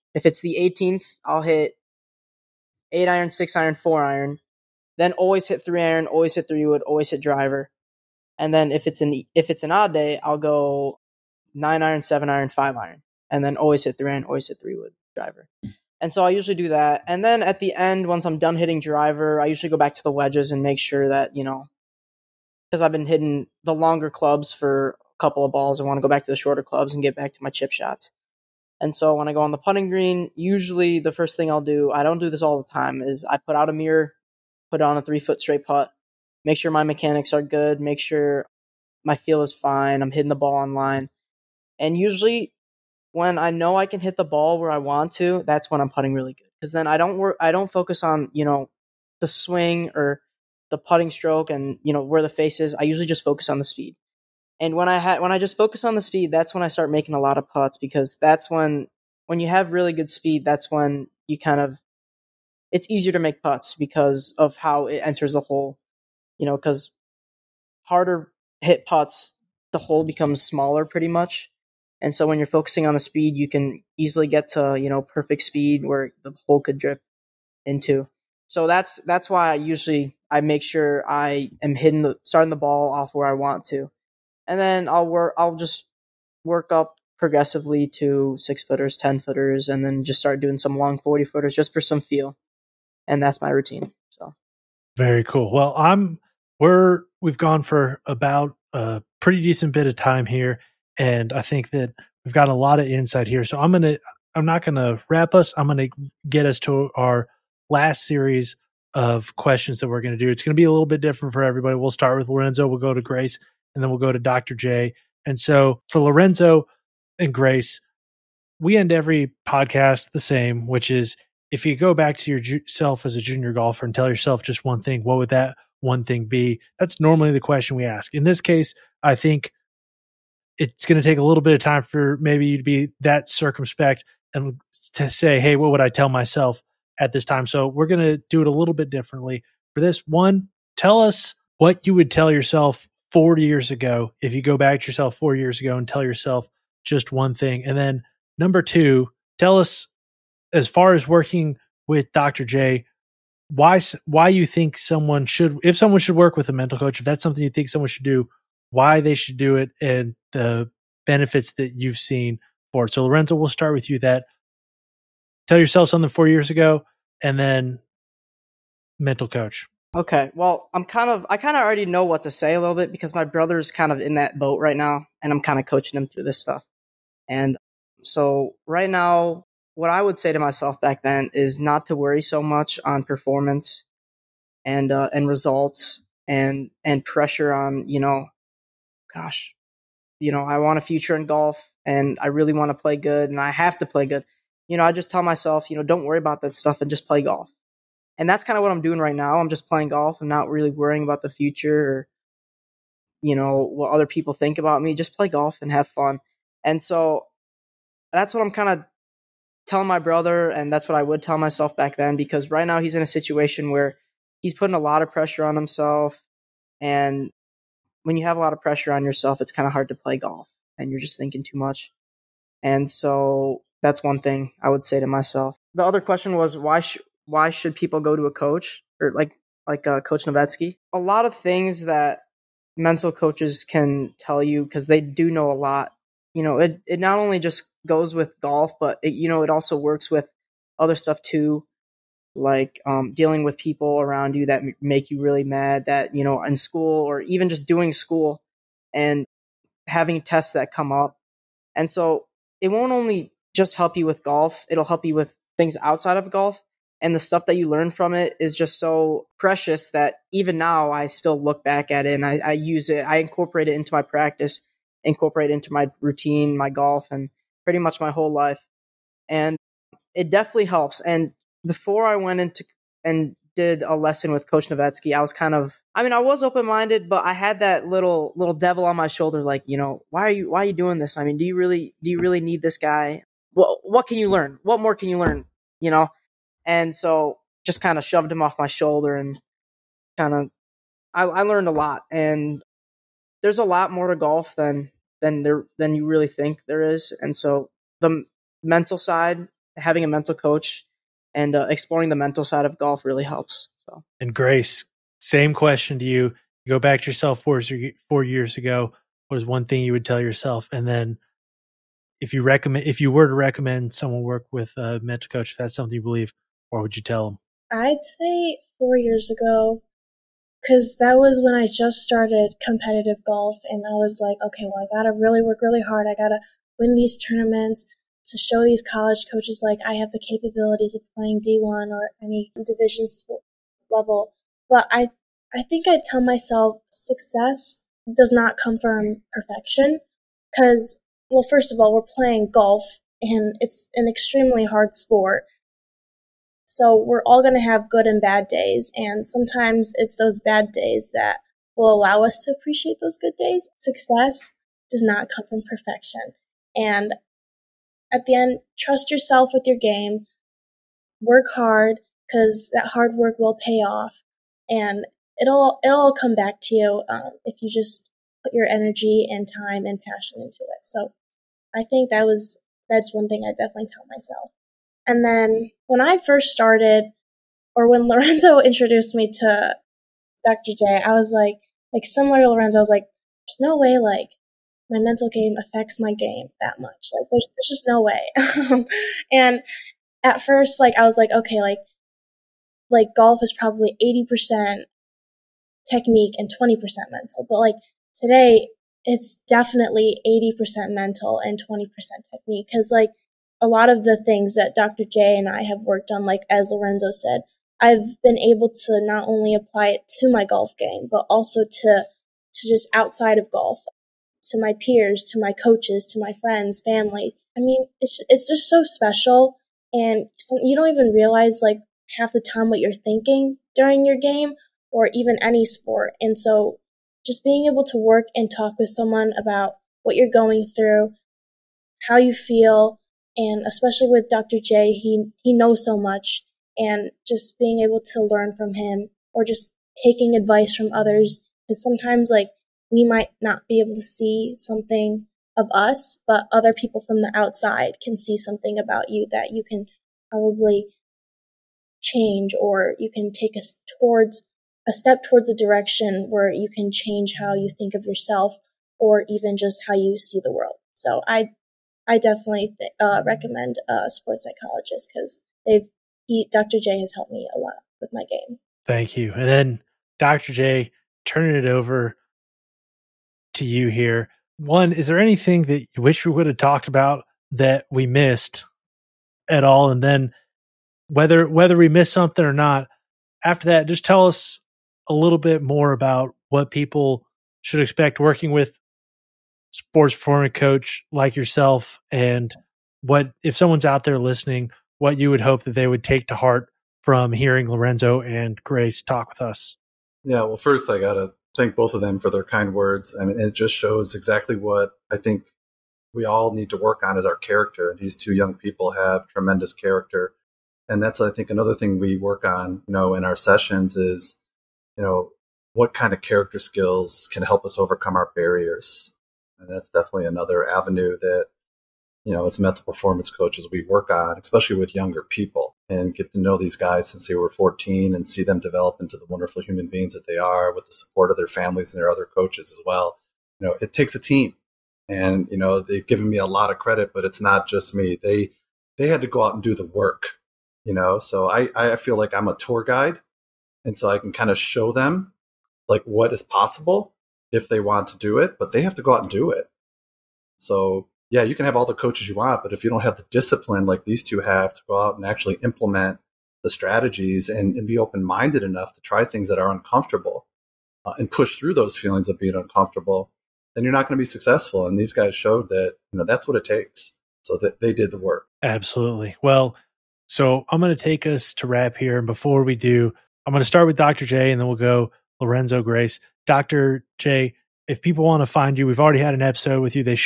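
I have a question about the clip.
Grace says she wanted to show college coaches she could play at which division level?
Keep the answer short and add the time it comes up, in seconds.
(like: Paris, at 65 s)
D1, at 331 s.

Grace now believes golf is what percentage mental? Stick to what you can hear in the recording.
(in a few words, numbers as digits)
80%.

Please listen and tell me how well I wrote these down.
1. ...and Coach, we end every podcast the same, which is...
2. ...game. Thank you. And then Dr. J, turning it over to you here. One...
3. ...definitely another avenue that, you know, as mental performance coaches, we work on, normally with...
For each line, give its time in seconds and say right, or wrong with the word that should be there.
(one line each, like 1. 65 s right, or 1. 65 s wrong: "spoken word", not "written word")
1. 117 s wrong: "Grace", not "Coach"
2. 468 s right
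3. 519 s wrong: "especially", not "normally".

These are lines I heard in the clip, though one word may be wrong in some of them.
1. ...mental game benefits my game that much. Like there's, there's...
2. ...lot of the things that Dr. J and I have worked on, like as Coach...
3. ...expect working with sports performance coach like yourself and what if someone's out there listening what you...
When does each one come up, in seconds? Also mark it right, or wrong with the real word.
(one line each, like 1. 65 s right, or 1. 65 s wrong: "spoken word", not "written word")
1. 384 s wrong: "affects", not "benefits"
2. 403 s wrong: "Lorenzo", not "Coach"
3. 487 s right.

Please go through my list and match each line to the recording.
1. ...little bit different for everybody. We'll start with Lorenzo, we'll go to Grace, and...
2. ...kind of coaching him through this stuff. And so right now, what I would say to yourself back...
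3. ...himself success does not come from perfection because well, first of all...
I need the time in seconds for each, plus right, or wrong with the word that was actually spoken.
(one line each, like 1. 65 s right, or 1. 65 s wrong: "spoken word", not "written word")
1. 110 s right
2. 175 s wrong: "myself", not "yourself"
3. 336 s wrong: "myself", not "himself".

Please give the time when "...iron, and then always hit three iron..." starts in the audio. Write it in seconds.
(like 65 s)
12 s.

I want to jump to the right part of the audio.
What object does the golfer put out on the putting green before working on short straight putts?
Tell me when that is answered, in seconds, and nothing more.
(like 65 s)
33 s.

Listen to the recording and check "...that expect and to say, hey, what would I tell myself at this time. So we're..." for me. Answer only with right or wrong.
wrong.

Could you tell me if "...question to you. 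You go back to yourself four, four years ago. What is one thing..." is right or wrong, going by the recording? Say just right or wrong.
right.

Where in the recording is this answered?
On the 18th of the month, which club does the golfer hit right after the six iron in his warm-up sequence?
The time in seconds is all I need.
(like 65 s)
3 s.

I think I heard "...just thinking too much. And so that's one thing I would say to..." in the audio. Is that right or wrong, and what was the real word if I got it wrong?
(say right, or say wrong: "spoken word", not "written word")
right.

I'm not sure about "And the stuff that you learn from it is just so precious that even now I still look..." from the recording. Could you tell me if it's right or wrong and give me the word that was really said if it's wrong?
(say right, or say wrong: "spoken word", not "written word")
right.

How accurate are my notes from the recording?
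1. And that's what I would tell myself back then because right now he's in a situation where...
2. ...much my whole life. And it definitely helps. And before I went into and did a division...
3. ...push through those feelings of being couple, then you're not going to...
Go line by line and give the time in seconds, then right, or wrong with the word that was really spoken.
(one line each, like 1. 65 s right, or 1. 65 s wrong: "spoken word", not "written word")
1. 210 s right
2. 267 s wrong: "lesson", not "division"
3. 561 s wrong: "uncomfortable", not "couple".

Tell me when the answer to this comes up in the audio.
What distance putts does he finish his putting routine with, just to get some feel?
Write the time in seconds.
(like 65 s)
90 s.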